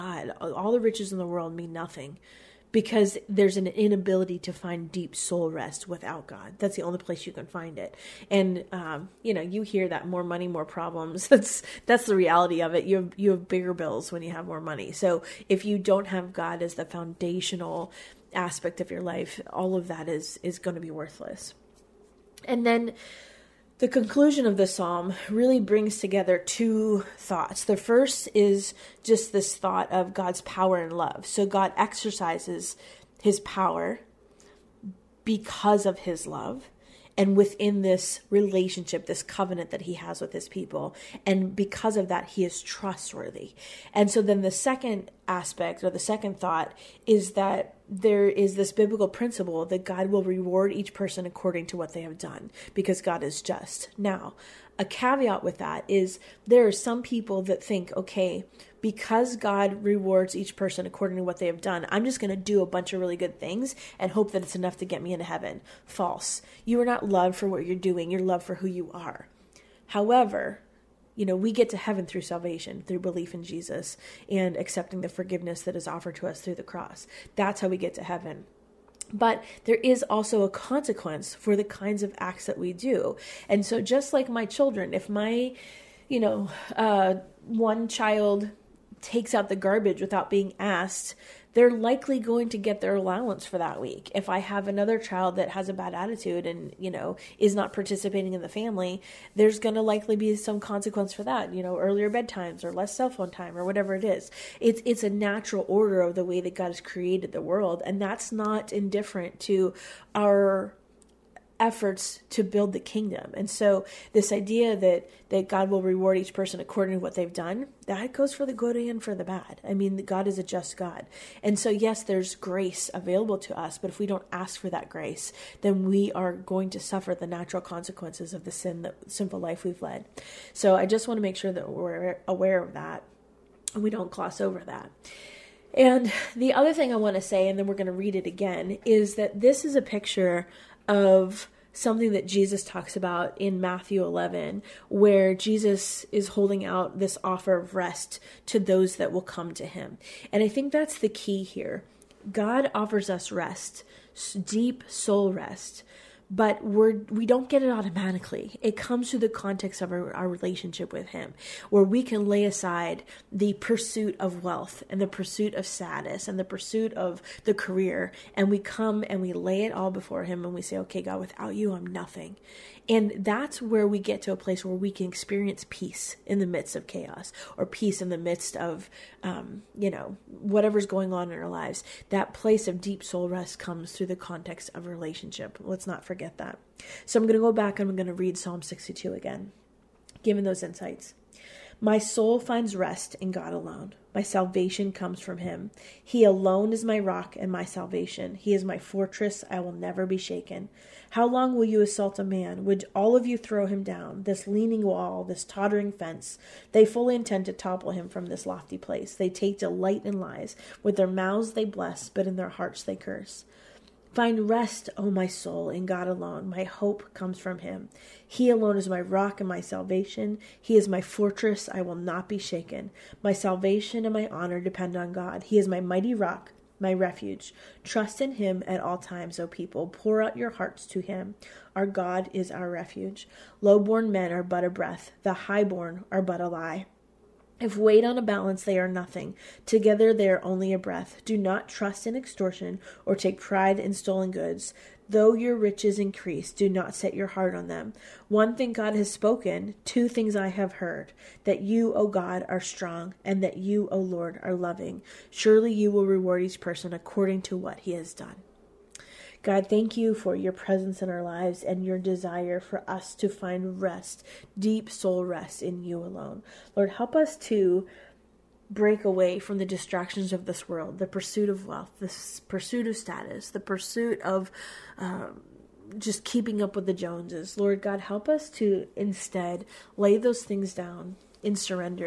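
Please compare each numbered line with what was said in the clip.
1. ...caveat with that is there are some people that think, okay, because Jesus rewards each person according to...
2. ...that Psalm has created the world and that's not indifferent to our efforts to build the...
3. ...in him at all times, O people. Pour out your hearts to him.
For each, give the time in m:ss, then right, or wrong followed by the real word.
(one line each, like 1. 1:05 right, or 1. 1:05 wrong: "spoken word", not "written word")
1. 0:54 wrong: "God", not "Jesus"
2. 1:46 wrong: "God", not "Psalm"
3. 3:48 right.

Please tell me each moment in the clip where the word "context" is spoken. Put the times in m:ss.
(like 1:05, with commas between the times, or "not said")
2:39, 3:04.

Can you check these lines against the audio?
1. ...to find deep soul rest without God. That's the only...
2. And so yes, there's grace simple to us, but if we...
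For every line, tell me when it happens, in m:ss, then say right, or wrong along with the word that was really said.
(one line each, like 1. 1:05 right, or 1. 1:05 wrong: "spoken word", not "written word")
1. 0:04 right
2. 2:01 wrong: "available", not "simple".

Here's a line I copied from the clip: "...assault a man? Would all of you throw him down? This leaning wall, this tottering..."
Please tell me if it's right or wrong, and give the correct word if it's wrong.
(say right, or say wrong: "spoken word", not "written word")
right.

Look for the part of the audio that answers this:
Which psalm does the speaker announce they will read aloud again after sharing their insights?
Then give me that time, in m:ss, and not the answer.
3:08.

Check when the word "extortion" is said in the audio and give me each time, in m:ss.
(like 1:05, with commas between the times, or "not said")
4:02.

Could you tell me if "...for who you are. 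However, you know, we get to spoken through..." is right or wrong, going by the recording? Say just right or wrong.
wrong.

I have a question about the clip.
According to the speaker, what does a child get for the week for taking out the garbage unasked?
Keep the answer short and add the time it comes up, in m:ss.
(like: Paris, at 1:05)
their allowance, at 1:32.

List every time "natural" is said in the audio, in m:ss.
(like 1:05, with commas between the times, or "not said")
1:45, 2:07.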